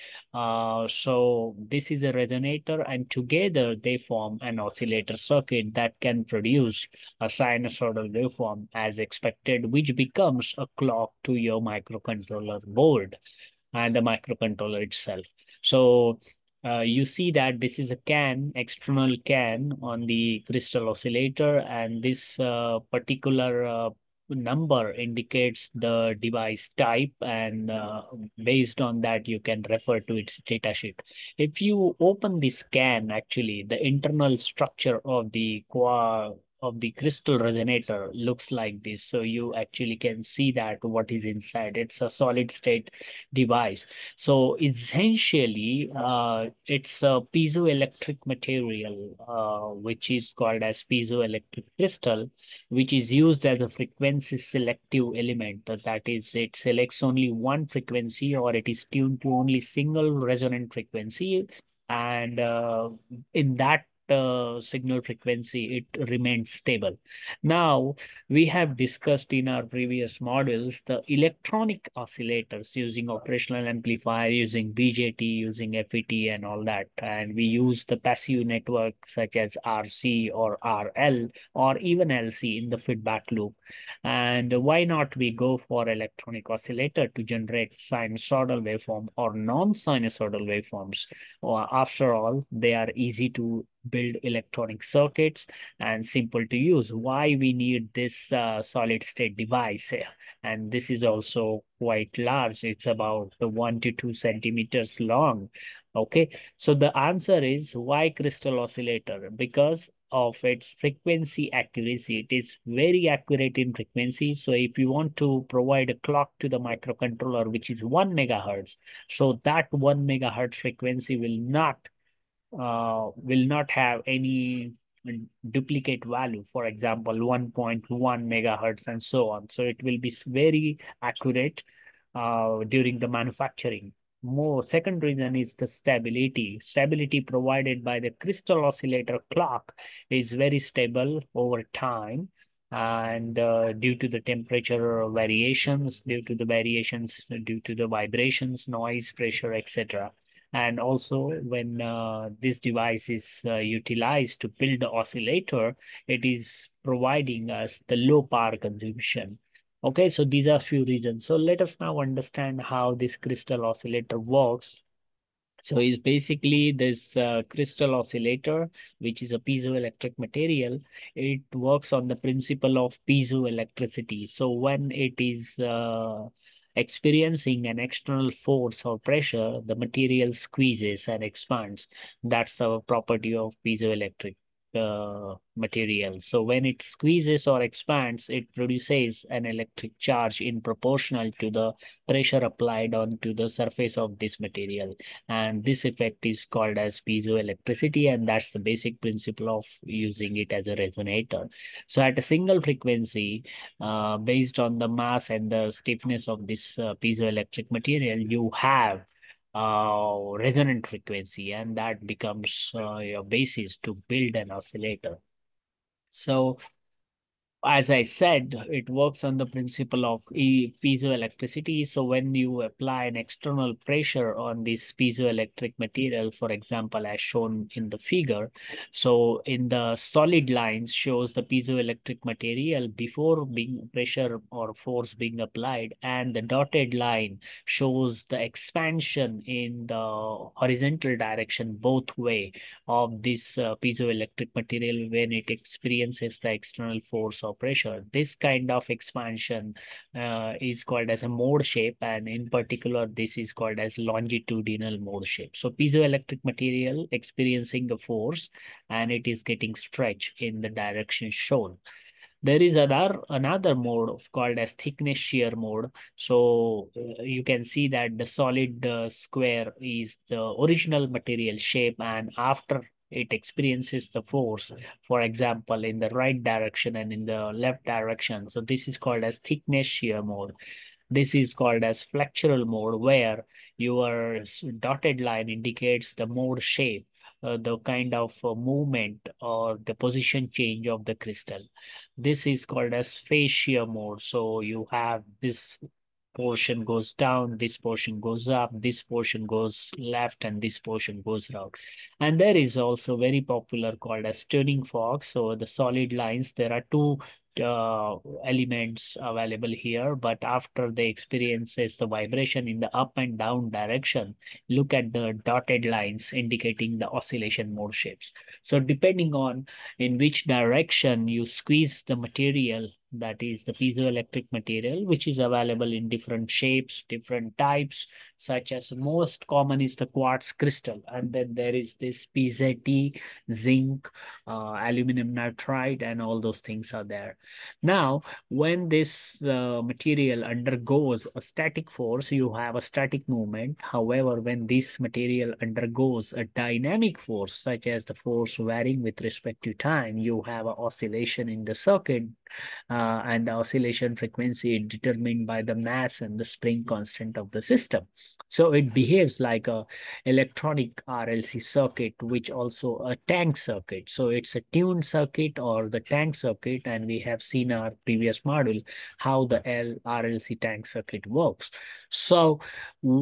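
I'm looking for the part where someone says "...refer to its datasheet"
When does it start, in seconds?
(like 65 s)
29 s.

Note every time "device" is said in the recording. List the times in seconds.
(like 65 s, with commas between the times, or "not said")
26 s, 43 s, 99 s, 152 s.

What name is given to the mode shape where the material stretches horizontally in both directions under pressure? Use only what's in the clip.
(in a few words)
longitudinal mode.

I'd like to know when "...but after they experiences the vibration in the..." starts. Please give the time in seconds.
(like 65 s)
310 s.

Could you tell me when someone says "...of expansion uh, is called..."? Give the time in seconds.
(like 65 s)
248 s.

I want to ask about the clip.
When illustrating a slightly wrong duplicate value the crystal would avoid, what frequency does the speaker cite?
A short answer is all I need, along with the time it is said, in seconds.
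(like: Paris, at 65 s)
1.1 megahertz, at 127 s.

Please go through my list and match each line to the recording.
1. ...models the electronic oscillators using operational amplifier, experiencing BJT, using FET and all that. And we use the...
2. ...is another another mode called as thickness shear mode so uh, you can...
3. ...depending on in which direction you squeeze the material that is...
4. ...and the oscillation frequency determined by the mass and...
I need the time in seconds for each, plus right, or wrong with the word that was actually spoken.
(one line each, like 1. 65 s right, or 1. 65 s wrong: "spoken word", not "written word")
1. 70 s wrong: "using", not "experiencing"
2. 262 s right
3. 318 s right
4. 353 s right.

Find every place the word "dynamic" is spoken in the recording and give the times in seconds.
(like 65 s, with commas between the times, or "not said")
346 s.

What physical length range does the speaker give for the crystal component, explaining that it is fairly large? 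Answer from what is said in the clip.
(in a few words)
1 to 2 centimeters.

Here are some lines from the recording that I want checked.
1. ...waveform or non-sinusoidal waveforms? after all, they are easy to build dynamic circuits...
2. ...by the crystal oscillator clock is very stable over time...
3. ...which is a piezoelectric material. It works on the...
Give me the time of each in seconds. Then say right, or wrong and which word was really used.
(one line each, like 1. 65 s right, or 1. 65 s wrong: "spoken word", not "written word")
1. 88 s wrong: "electronic", not "dynamic"
2. 137 s right
3. 168 s right.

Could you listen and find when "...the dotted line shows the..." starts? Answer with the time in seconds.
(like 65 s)
236 s.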